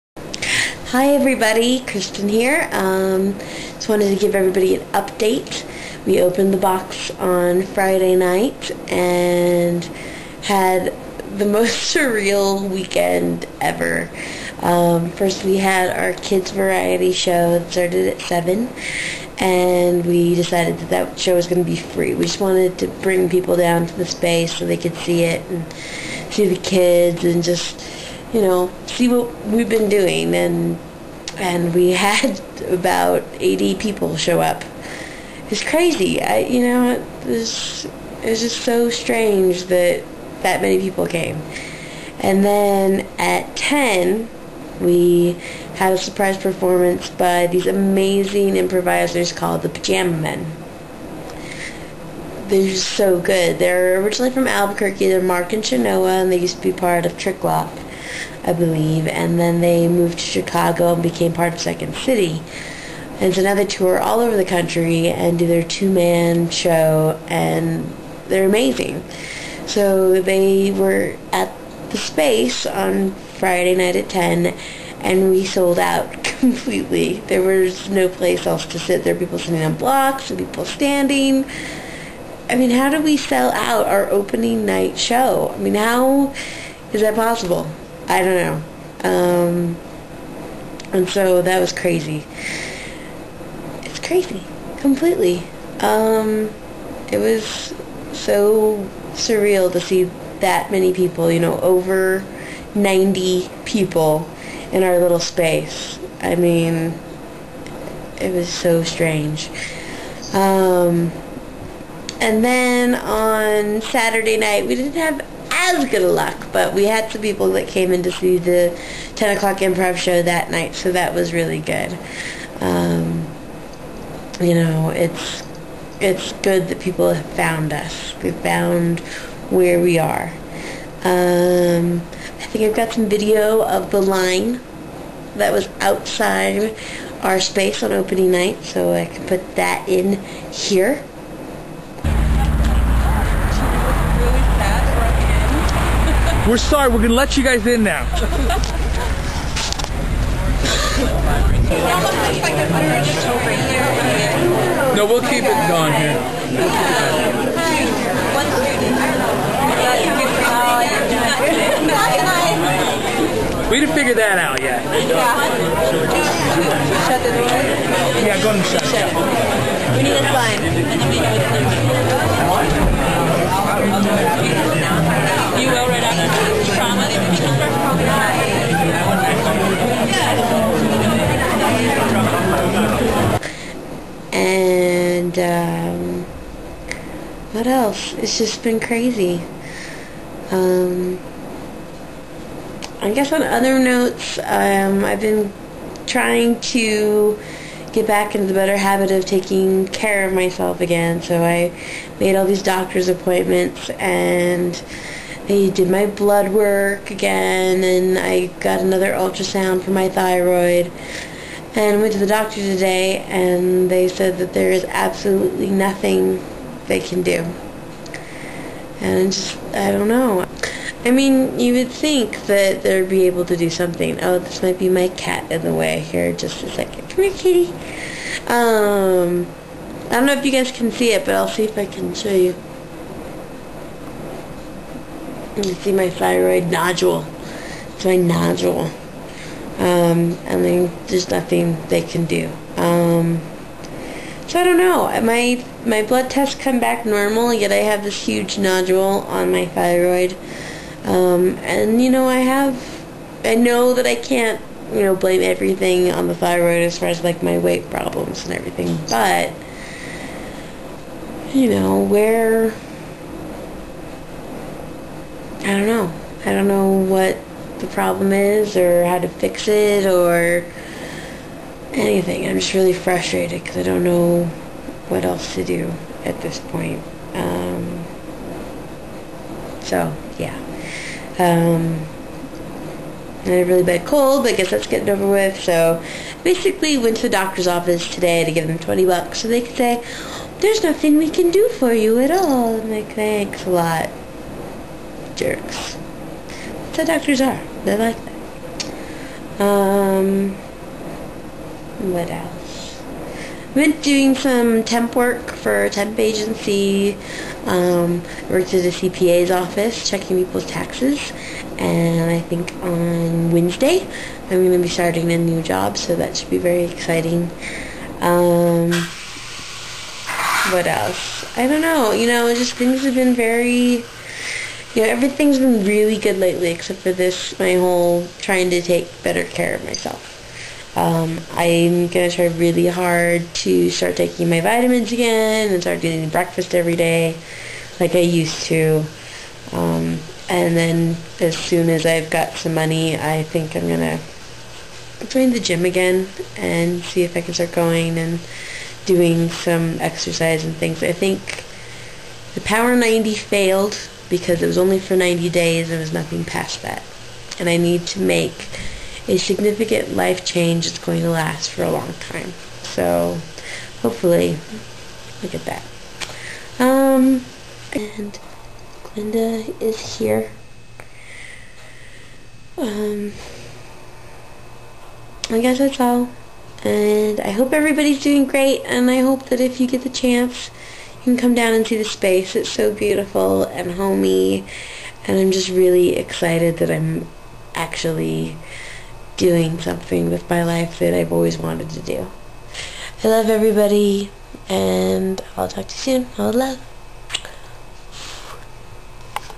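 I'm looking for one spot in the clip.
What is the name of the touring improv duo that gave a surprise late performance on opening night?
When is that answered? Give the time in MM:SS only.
00:49.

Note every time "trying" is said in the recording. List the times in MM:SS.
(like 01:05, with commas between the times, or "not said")
03:16, 05:28.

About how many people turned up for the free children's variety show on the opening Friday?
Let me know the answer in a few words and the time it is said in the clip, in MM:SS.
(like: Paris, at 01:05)
80, at 00:32.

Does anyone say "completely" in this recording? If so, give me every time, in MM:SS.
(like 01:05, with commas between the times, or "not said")
01:16, 01:34.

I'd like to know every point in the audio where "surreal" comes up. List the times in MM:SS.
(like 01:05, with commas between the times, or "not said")
00:11, 01:39.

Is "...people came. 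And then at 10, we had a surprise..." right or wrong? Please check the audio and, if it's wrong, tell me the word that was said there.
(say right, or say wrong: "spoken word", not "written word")
right.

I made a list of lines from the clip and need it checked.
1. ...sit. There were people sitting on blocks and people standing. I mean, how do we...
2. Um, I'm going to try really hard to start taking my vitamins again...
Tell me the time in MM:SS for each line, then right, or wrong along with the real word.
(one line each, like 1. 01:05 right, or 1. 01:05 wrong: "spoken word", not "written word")
1. 01:18 right
2. 05:30 right.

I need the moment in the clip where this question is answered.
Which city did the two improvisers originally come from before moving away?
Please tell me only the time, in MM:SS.
00:54.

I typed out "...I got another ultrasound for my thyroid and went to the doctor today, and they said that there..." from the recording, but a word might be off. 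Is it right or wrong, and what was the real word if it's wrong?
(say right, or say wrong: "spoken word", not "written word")
right.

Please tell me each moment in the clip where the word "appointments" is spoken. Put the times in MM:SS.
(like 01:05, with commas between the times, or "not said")
03:23.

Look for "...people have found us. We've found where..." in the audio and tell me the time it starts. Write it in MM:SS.
02:06.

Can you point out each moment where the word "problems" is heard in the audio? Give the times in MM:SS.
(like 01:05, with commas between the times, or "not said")
04:17, 04:27.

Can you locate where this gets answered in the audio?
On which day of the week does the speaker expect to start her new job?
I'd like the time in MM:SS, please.
05:13.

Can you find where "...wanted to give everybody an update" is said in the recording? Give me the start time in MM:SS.
00:03.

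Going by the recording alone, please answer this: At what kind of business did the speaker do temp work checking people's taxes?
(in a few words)
CPA's office.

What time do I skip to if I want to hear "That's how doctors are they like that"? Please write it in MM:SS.
04:56.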